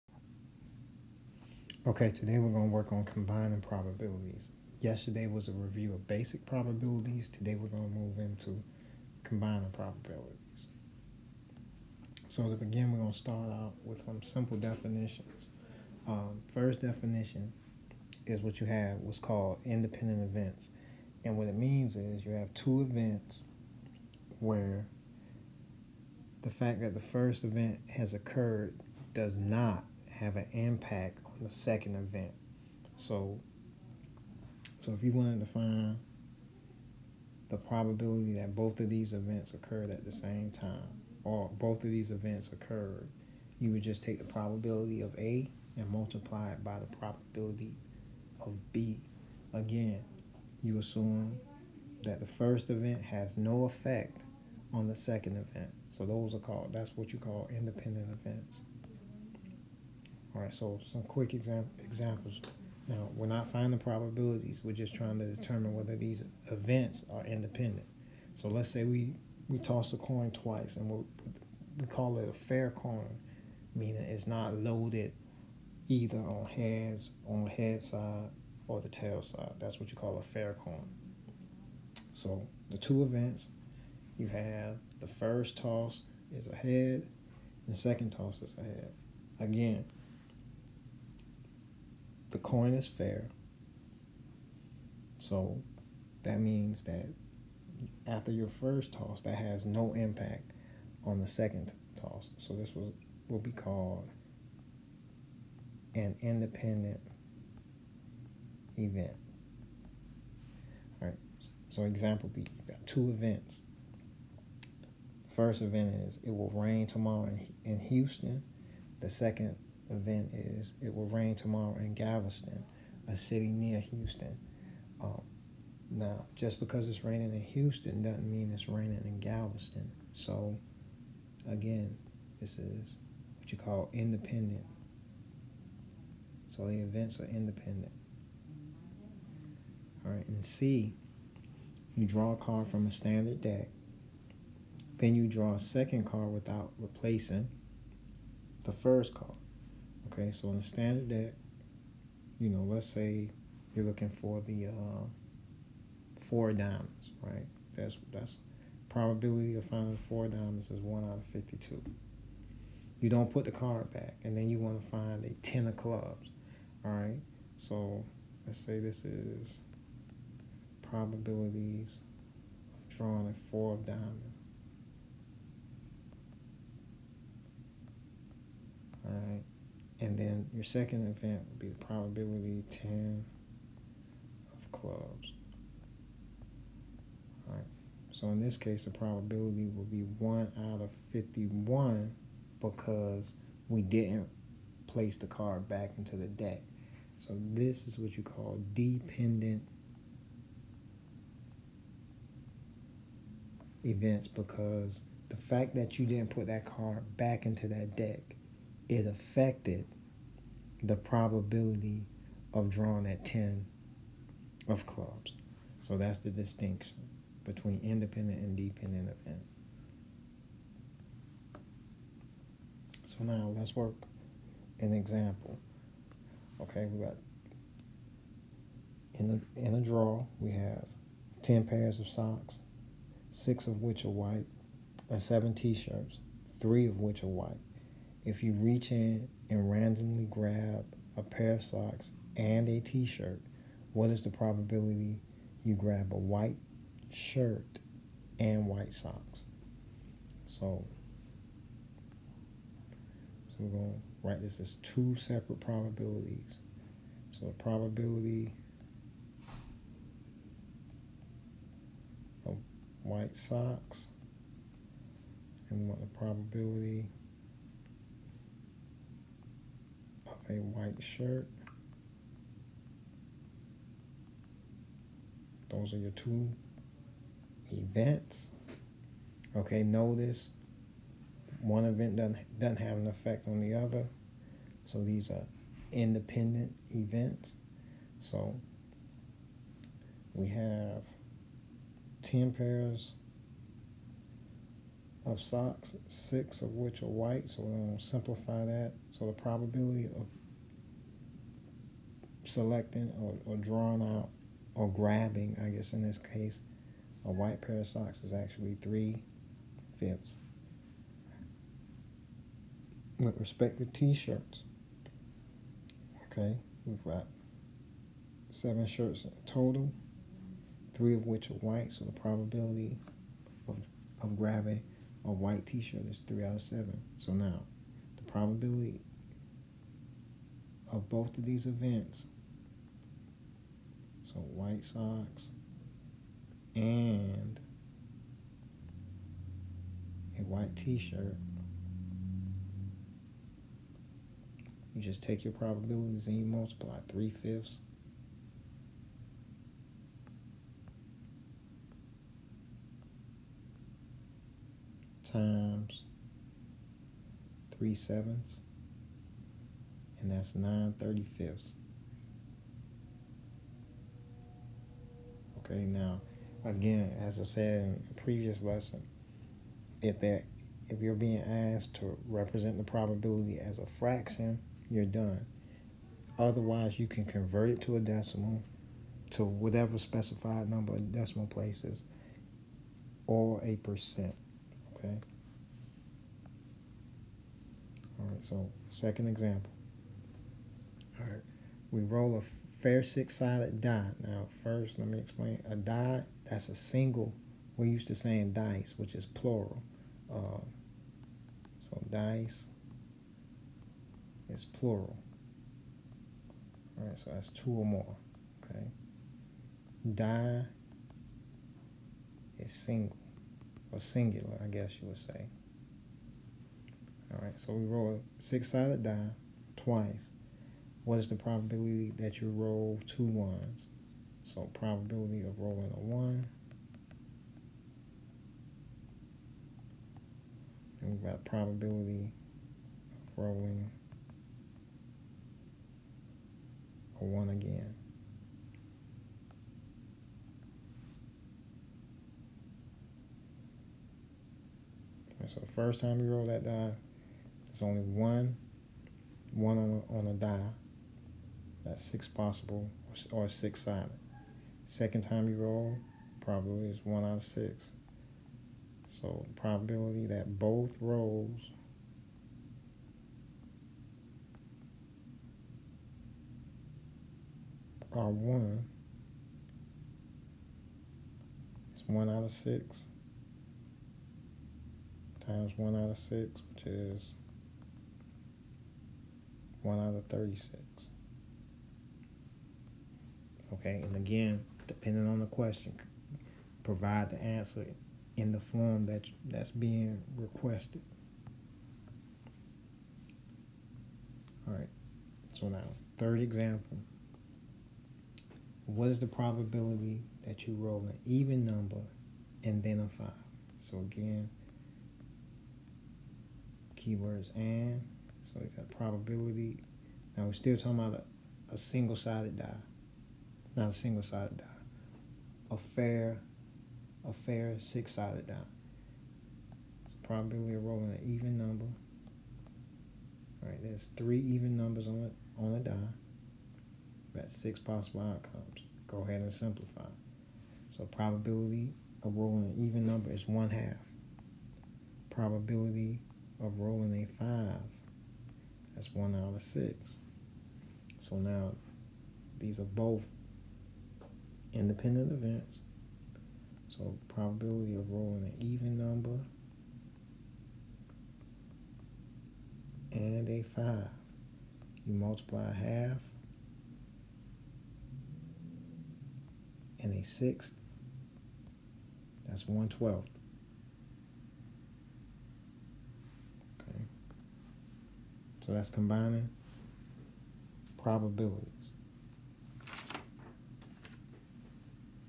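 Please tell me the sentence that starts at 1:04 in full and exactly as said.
We're just trying to determine whether these events are independent.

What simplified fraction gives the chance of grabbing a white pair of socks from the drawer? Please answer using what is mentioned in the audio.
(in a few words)
3/5.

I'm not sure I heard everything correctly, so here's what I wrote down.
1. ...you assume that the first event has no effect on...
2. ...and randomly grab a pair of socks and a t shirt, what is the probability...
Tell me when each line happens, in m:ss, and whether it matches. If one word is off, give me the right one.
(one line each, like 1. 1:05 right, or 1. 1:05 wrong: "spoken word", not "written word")
1. 0:50 right
2. 3:59 right.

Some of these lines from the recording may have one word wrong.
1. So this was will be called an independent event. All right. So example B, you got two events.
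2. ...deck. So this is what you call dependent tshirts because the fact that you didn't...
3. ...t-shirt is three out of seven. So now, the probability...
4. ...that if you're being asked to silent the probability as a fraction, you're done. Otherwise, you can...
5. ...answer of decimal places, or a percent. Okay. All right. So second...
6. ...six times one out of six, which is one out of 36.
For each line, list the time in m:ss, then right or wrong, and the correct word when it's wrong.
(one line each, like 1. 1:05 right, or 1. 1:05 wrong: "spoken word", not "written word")
1. 1:42 right
2. 3:16 wrong: "events", not "tshirts"
3. 5:25 right
4. 6:10 wrong: "represent", not "silent"
5. 6:20 wrong: "number", not "answer"
6. 7:52 right.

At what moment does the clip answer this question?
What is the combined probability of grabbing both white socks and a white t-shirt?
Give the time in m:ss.
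6:00.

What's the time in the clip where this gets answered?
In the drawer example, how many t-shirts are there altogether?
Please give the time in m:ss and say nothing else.
3:55.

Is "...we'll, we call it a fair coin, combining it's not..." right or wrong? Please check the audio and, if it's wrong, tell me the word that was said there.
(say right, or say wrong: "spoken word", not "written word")
wrong: "meaning", not "combining".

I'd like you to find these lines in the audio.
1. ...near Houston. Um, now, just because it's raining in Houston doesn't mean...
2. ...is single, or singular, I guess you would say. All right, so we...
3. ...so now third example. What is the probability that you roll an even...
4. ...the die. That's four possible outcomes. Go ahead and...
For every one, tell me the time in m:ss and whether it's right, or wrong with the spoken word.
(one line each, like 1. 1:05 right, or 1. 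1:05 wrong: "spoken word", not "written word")
1. 2:03 right
2. 6:52 right
3. 8:15 right
4. 8:45 wrong: "six", not "four".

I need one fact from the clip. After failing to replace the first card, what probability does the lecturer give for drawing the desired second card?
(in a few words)
1/51.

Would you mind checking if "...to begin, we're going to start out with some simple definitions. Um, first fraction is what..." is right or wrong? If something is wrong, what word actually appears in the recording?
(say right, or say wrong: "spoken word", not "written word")
wrong: "definition", not "fraction".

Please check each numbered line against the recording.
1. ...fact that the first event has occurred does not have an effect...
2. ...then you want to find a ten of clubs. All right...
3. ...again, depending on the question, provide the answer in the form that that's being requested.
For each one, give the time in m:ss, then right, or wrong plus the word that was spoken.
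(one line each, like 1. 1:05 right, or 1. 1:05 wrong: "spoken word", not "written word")
1. 0:26 wrong: "impact", not "effect"
2. 2:44 right
3. 8:04 right.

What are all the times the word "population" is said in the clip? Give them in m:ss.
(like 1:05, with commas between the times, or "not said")
not said.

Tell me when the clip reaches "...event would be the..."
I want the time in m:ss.
3:01.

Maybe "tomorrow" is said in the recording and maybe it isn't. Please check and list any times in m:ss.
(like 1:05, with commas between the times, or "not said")
1:56, 2:01.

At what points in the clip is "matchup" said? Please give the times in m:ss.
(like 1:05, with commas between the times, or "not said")
not said.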